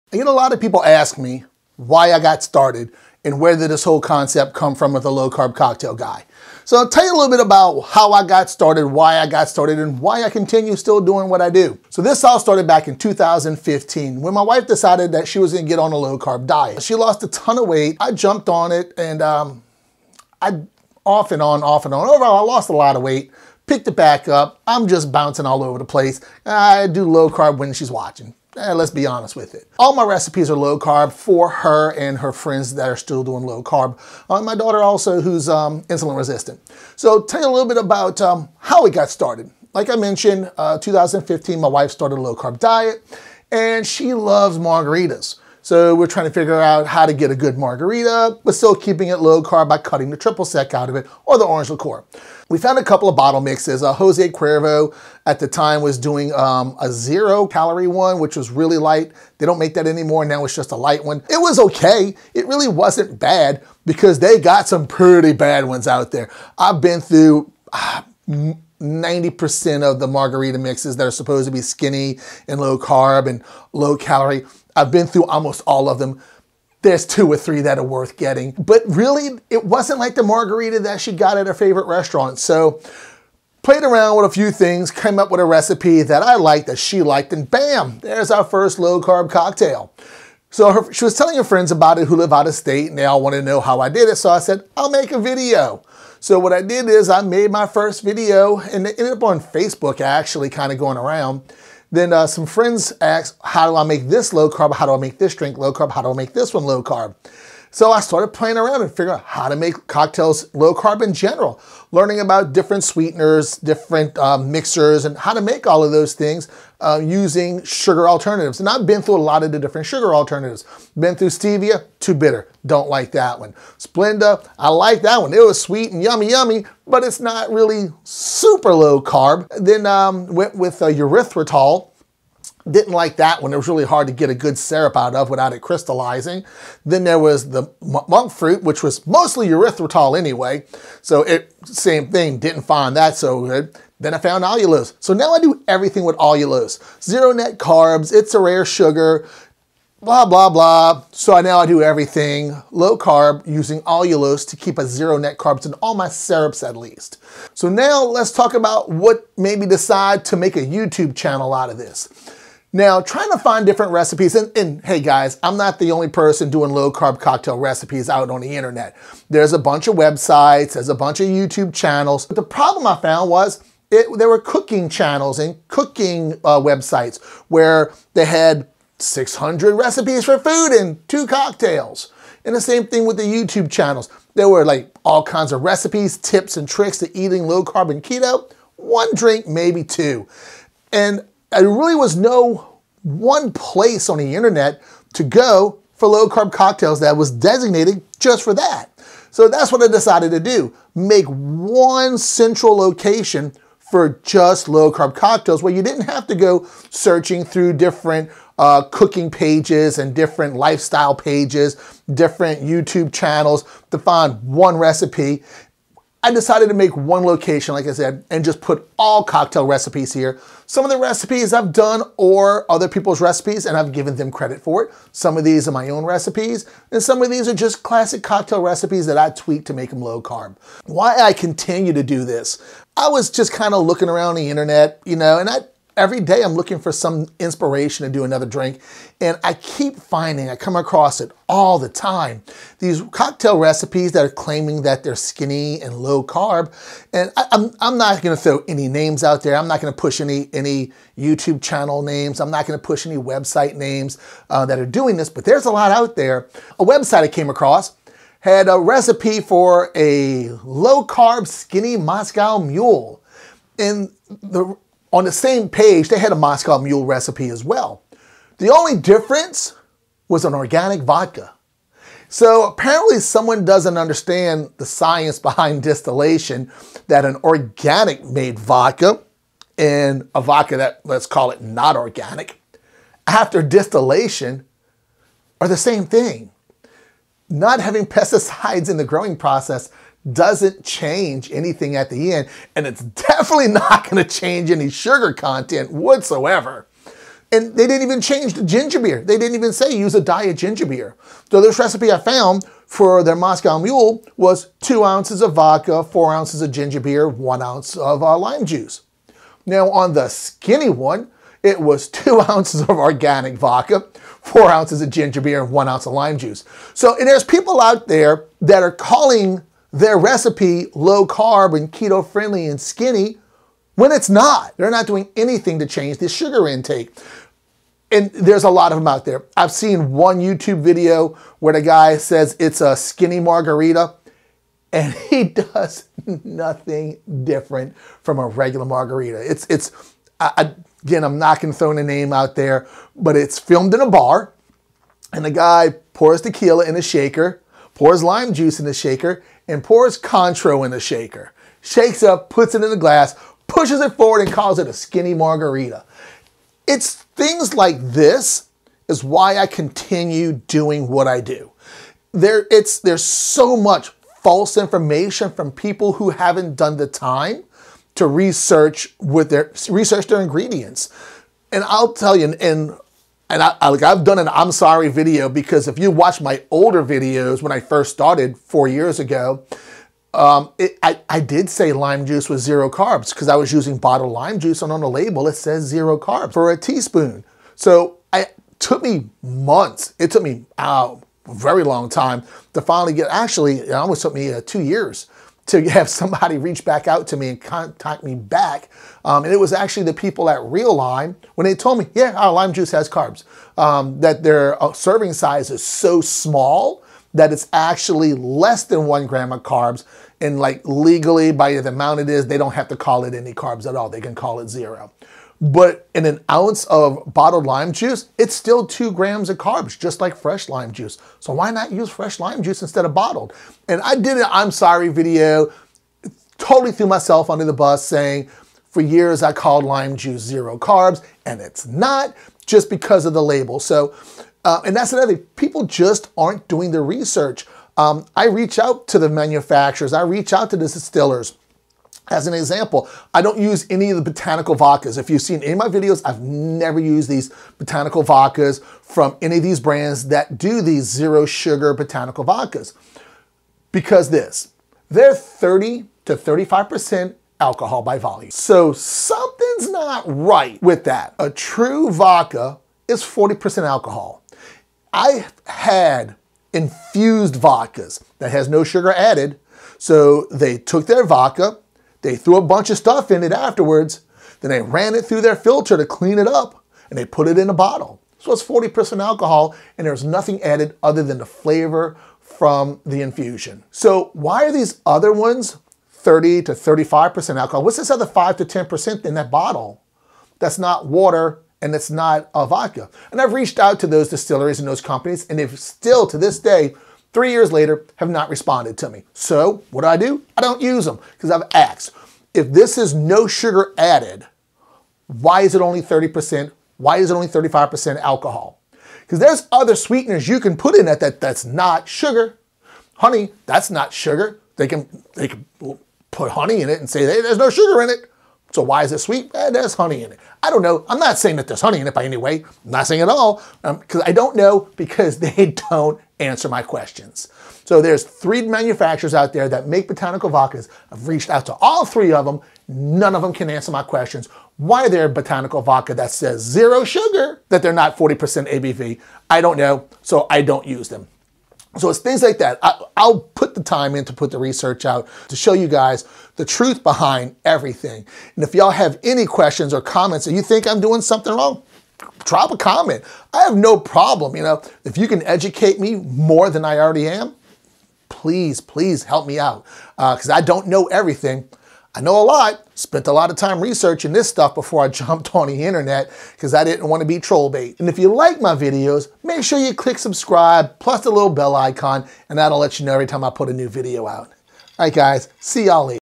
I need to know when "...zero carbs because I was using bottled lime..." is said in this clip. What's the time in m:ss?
6:22.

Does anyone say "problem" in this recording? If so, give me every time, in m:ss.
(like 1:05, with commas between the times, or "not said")
2:52, 9:13.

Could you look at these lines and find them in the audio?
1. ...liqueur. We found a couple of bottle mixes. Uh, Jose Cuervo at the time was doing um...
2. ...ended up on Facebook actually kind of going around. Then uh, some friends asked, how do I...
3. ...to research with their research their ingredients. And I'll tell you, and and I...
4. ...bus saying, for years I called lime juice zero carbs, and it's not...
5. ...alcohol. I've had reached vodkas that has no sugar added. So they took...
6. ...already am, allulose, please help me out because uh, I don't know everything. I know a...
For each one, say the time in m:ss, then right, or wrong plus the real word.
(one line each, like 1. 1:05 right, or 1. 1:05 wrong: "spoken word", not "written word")
1. 0:51 right
2. 1:38 right
3. 6:08 right
4. 7:07 right
5. 7:43 wrong: "infused", not "reached"
6. 9:16 wrong: "please", not "allulose".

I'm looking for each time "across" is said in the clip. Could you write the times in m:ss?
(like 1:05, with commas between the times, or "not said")
4:00, 4:17.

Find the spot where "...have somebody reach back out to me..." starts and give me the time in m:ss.
6:35.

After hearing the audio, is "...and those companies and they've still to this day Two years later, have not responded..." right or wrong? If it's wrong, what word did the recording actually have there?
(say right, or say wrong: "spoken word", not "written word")
wrong: "Three", not "Two".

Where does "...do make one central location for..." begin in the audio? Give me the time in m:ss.
3:20.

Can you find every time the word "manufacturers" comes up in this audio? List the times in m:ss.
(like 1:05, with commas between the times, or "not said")
7:19, 8:48.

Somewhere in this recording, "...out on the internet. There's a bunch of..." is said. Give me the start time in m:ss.
2:48.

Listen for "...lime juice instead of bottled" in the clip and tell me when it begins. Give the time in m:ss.
7:02.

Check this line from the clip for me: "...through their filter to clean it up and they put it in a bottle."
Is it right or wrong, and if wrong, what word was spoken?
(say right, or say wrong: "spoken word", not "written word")
right.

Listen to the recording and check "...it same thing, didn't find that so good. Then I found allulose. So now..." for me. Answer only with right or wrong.
right.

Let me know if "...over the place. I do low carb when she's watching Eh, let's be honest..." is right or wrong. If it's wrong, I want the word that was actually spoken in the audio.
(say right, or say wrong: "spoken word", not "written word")
right.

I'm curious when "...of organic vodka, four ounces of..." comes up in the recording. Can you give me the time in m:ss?
5:12.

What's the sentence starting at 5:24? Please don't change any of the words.
They're not doing anything to change the sugar intake.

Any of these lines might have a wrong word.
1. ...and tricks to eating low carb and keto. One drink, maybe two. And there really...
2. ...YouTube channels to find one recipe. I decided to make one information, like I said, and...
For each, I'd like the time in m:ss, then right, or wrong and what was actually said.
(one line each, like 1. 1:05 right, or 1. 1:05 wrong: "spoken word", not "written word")
1. 3:06 right
2. 3:32 wrong: "location", not "information".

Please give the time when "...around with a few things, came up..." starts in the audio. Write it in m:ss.
1:23.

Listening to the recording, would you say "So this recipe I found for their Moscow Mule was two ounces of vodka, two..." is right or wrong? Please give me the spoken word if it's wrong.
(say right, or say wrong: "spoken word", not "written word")
wrong: "four", not "two".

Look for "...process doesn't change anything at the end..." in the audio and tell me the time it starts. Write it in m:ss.
4:49.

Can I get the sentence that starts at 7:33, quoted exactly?
Because this, they're 30 to 35% alcohol by volume.